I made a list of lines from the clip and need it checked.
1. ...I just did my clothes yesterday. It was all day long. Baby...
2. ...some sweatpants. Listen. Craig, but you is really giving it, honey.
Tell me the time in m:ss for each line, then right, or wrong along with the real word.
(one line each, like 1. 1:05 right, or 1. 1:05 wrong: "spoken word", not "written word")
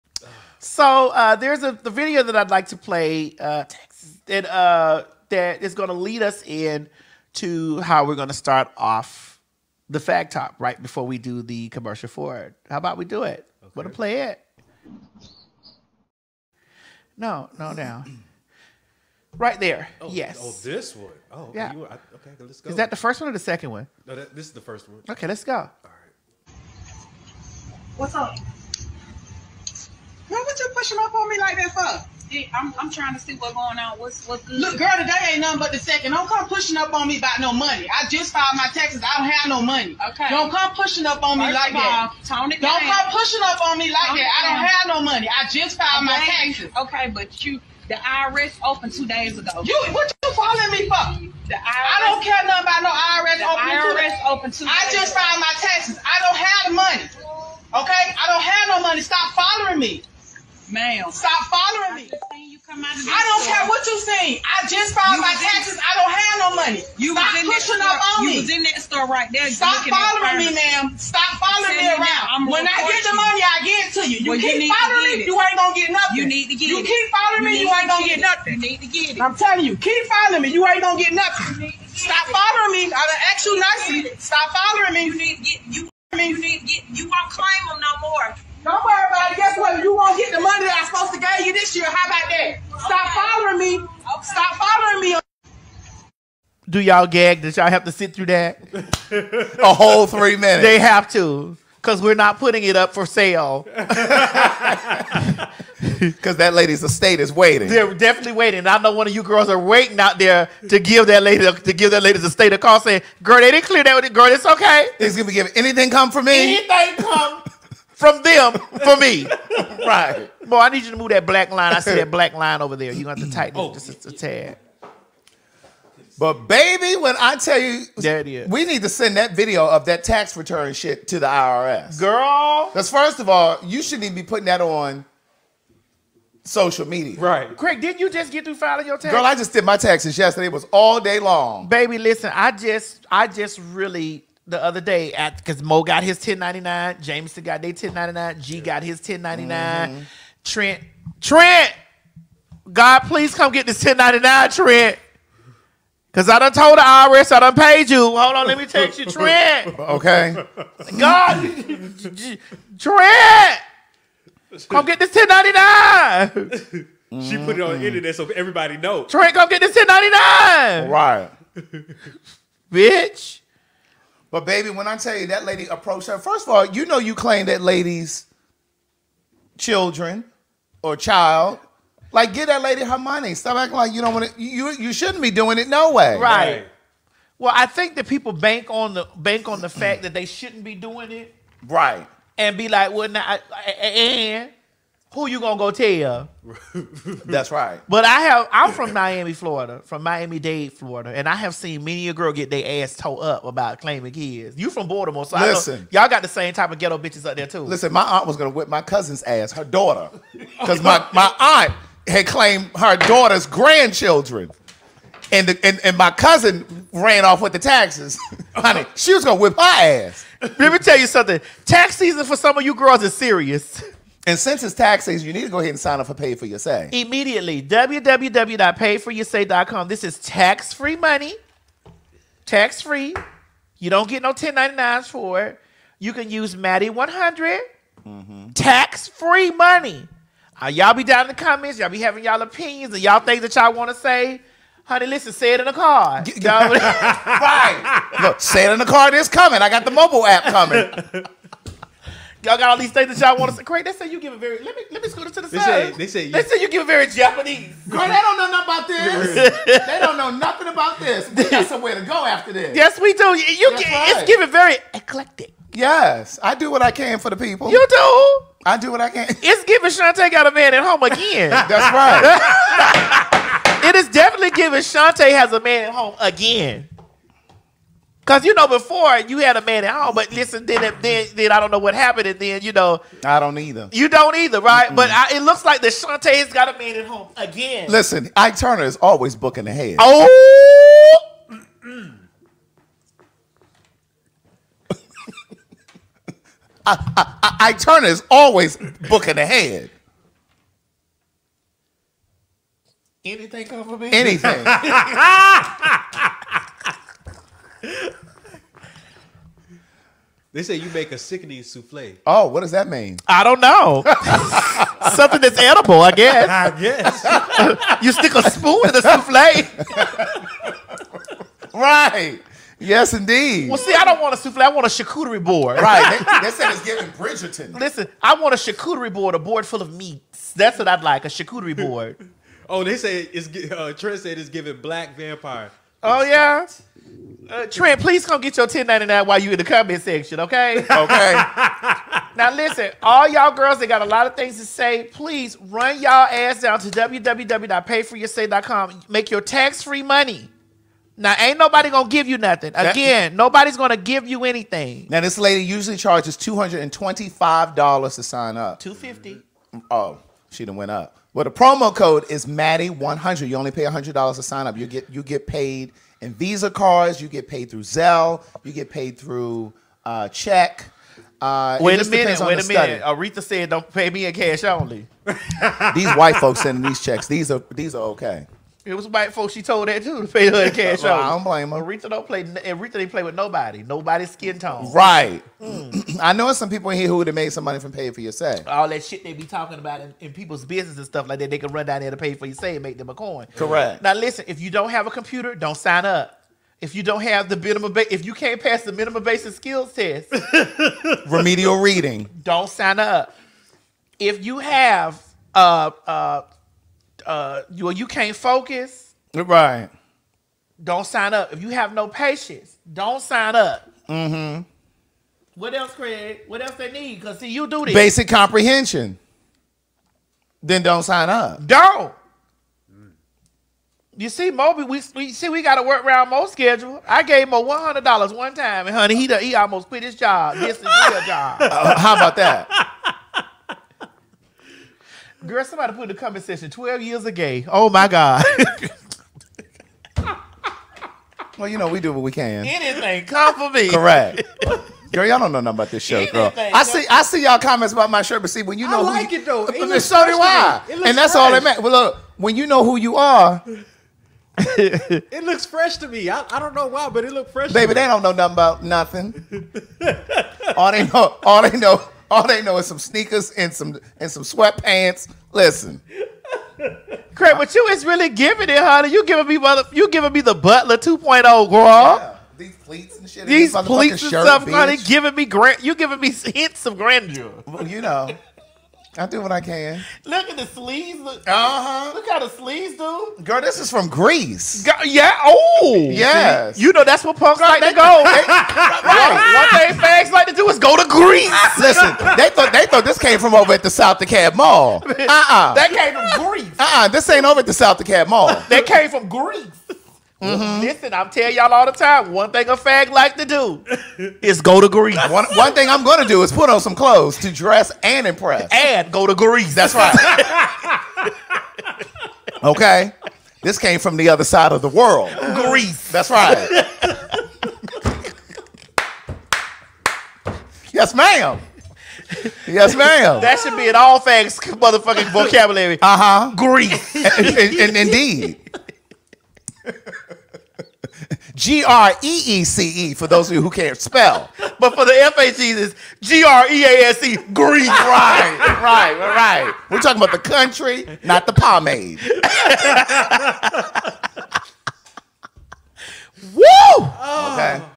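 1. 2:19 wrong: "taxes", not "clothes"
2. 7:44 right.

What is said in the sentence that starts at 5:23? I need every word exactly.
Well, see, I don't want a souffle.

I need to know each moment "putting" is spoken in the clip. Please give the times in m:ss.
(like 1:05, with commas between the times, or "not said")
1:42, 2:14.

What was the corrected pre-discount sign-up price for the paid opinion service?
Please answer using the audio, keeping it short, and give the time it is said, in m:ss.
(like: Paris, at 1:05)
$250, at 5:58.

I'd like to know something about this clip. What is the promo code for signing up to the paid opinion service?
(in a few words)
Maddie 100.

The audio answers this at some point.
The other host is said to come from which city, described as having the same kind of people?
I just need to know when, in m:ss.
3:24.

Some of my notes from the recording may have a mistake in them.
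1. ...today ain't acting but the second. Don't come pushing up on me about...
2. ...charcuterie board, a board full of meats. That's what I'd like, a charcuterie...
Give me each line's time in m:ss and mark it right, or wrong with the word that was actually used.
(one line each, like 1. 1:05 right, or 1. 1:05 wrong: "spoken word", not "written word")
1. 0:34 wrong: "nothing", not "acting"
2. 5:28 right.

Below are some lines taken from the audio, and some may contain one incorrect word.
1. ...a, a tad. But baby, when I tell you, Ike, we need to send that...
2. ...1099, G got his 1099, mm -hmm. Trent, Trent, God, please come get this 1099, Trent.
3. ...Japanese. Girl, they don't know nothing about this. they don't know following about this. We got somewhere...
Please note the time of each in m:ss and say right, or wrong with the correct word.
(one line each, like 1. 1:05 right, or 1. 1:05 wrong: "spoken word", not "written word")
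1. 2:04 wrong: "Daddy", not "Ike"
2. 2:27 right
3. 4:17 wrong: "nothing", not "following".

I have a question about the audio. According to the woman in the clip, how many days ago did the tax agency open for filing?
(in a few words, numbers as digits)
2 days.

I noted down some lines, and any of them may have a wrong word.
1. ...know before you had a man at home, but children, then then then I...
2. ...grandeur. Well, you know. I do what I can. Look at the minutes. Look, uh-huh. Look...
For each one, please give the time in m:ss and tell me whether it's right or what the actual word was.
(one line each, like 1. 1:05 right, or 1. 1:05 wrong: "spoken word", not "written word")
1. 4:38 wrong: "listen", not "children"
2. 7:56 wrong: "sleeves", not "minutes".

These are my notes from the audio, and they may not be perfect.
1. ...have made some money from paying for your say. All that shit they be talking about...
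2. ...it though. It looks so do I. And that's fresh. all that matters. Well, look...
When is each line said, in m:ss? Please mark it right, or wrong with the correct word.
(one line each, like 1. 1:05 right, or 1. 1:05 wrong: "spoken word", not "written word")
1. 6:27 right
2. 7:29 right.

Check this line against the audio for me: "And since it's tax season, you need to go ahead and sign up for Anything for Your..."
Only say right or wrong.
wrong.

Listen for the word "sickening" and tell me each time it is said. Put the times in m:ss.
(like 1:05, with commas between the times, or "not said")
5:11.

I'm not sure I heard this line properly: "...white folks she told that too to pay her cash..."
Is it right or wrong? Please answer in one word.
right.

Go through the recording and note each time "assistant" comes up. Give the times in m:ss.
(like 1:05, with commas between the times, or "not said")
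not said.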